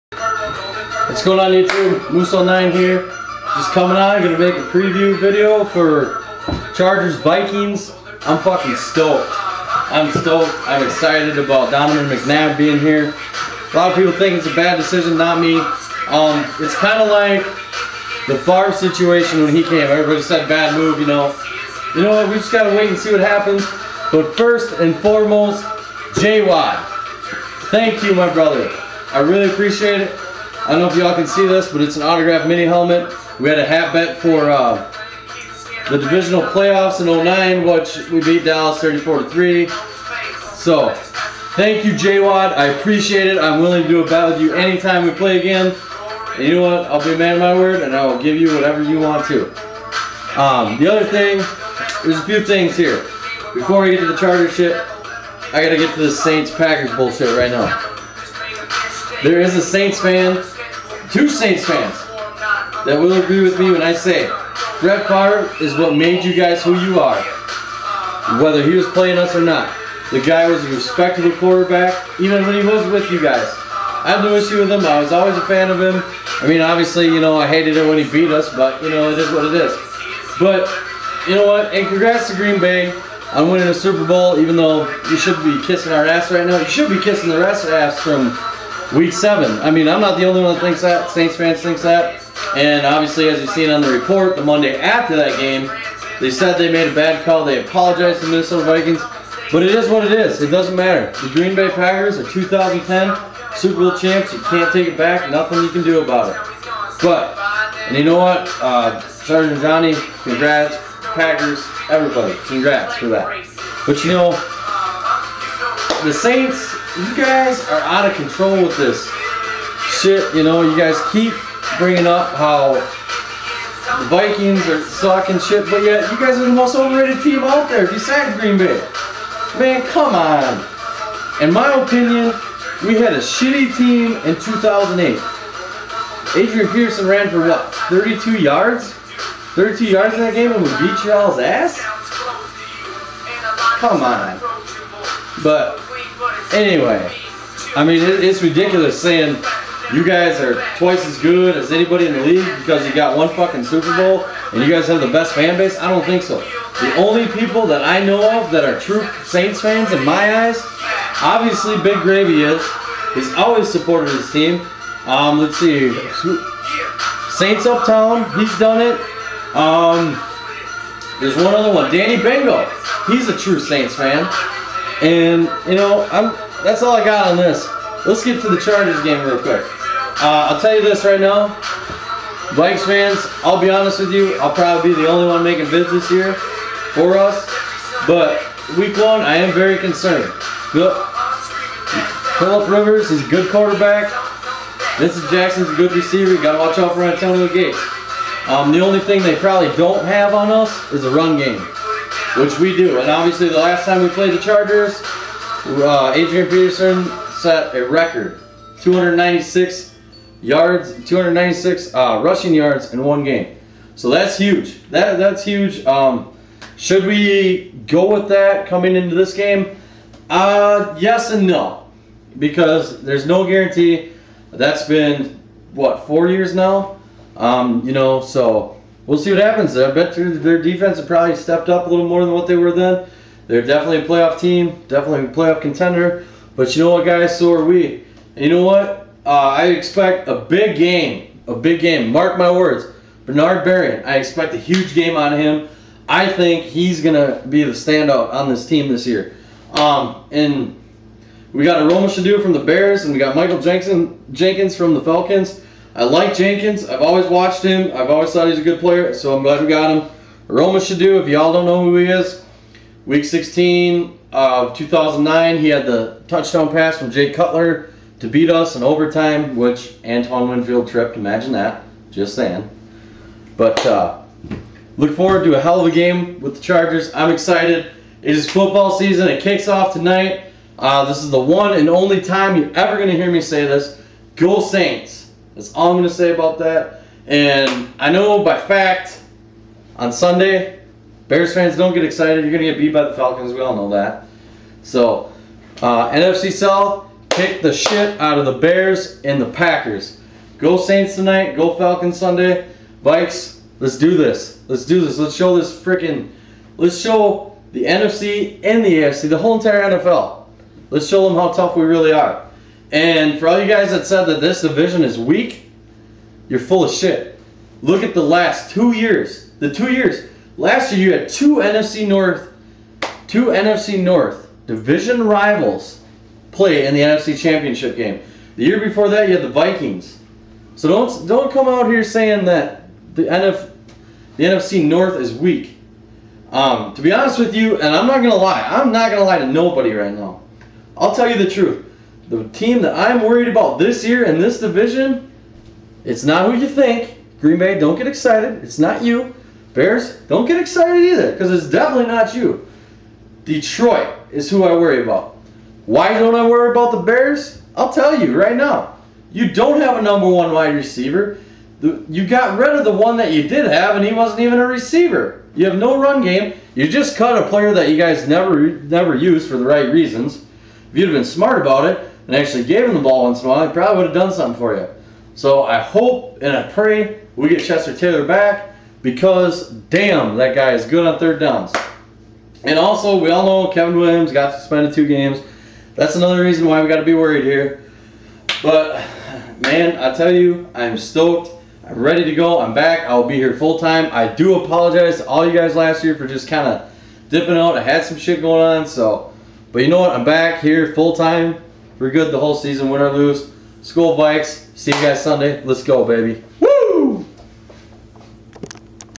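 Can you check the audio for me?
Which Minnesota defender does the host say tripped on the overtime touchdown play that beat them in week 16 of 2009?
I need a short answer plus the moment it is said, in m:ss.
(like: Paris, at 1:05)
Antoine Winfield, at 4:30.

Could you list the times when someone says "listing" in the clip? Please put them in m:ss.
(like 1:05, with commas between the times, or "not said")
not said.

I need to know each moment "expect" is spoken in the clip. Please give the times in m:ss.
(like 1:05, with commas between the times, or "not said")
3:59, 4:04.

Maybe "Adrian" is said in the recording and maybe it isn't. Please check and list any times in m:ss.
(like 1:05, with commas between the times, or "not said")
2:16, 3:26.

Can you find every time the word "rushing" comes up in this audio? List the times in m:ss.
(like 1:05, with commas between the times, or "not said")
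3:32.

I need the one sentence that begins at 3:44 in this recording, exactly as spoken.
That's been what four years now.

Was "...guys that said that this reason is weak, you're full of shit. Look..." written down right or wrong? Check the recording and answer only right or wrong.
wrong.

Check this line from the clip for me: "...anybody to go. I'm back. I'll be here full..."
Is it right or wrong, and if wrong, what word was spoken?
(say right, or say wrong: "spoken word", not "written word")
wrong: "ready", not "anybody".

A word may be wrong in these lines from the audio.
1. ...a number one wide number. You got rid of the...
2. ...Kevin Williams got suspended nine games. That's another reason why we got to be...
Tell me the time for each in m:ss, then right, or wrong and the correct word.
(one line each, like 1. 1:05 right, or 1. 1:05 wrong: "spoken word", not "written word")
1. 5:59 wrong: "receiver", not "number"
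2. 6:23 wrong: "two", not "nine".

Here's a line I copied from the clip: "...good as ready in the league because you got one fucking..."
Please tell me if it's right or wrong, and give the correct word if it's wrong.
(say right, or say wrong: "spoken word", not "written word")
wrong: "anybody", not "ready".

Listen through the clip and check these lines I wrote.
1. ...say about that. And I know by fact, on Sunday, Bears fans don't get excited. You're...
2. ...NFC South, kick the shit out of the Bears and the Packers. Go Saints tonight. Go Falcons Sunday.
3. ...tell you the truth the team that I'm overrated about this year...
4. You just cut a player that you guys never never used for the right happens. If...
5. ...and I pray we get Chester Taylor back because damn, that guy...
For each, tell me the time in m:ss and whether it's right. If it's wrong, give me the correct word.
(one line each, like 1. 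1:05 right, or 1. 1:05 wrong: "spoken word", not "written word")
1. 4:46 right
2. 4:56 right
3. 5:41 wrong: "worried", not "overrated"
4. 6:06 wrong: "reasons", not "happens"
5. 6:16 right.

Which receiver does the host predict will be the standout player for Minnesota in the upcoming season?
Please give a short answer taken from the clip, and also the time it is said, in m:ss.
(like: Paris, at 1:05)
Bernard Berrian, at 4:03.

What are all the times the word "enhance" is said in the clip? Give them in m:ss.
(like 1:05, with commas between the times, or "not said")
not said.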